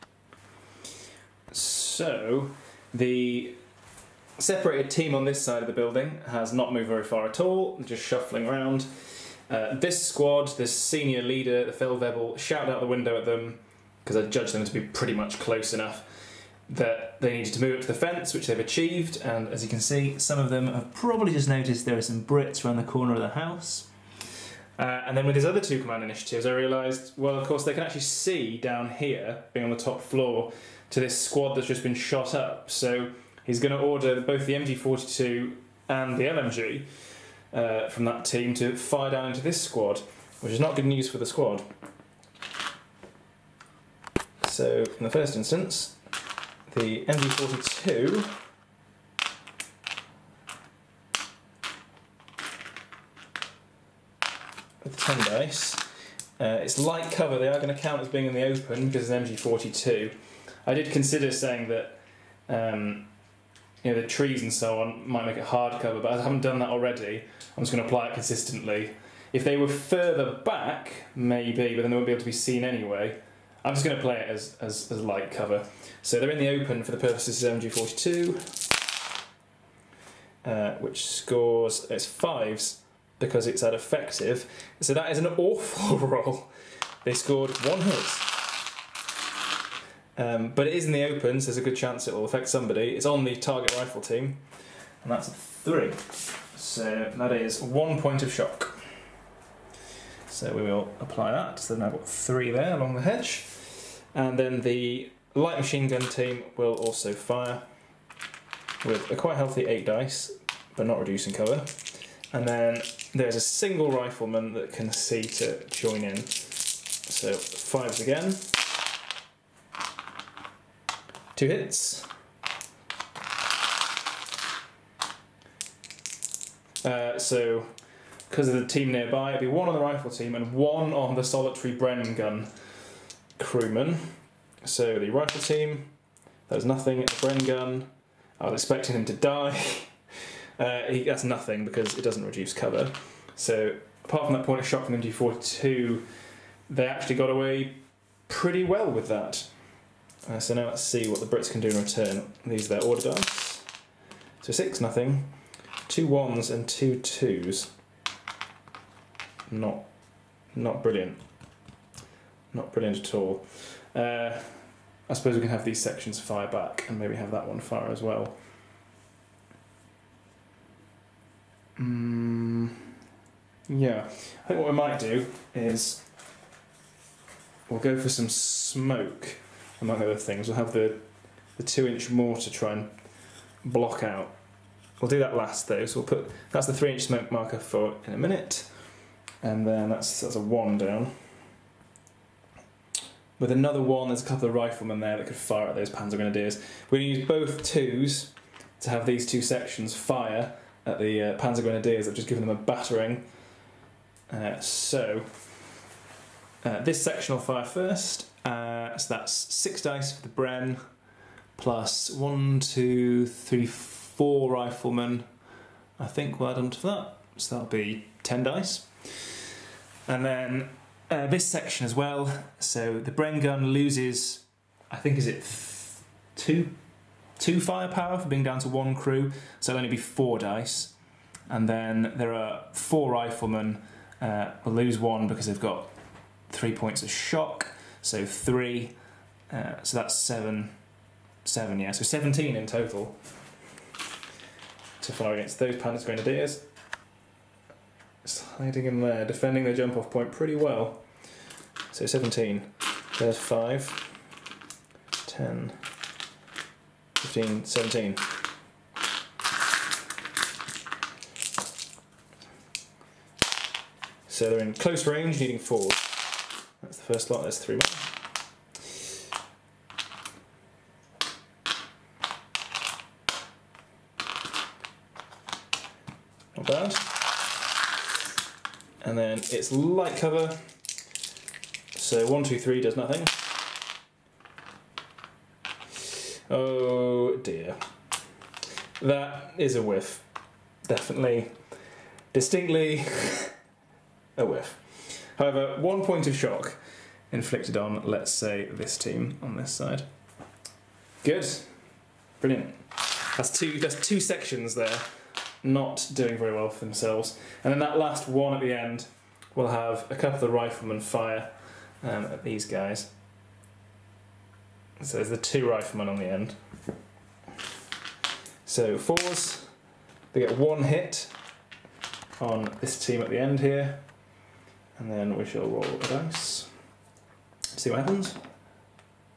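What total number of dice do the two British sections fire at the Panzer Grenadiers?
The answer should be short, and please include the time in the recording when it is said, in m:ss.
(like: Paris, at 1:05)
17, at 4:02.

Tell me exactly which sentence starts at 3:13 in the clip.
With another one, there's a couple of riflemen there that could fire at those Panzer Grenadiers.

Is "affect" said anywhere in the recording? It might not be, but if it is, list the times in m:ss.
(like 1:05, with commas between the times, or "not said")
1:32.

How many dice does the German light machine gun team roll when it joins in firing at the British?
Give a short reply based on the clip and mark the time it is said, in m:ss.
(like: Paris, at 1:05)
8, at 1:49.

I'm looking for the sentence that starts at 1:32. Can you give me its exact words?
It's on the target rifle team, and that's a three.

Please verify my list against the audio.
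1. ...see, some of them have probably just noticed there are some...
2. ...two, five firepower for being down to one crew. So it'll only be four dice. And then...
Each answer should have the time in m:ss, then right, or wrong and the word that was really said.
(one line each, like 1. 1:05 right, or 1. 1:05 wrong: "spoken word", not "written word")
1. 0:19 right
2. 3:46 wrong: "two", not "five".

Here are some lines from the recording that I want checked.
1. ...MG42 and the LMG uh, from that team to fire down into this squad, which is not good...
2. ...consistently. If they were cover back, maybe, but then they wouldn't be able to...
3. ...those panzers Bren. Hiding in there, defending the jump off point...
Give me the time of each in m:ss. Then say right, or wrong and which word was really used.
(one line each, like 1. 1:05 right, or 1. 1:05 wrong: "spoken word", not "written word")
1. 0:34 right
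2. 1:08 wrong: "further", not "cover"
3. 4:05 wrong: "Grenadiers", not "Bren".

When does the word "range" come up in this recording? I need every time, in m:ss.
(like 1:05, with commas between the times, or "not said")
4:25.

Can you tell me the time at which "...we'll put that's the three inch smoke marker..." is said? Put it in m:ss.
3:05.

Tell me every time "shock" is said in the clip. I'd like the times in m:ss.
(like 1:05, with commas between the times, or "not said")
1:38, 3:57, 4:56.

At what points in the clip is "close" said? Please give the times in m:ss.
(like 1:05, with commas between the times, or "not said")
0:15, 4:24.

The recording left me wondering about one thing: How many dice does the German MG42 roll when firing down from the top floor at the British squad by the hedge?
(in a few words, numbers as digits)
10.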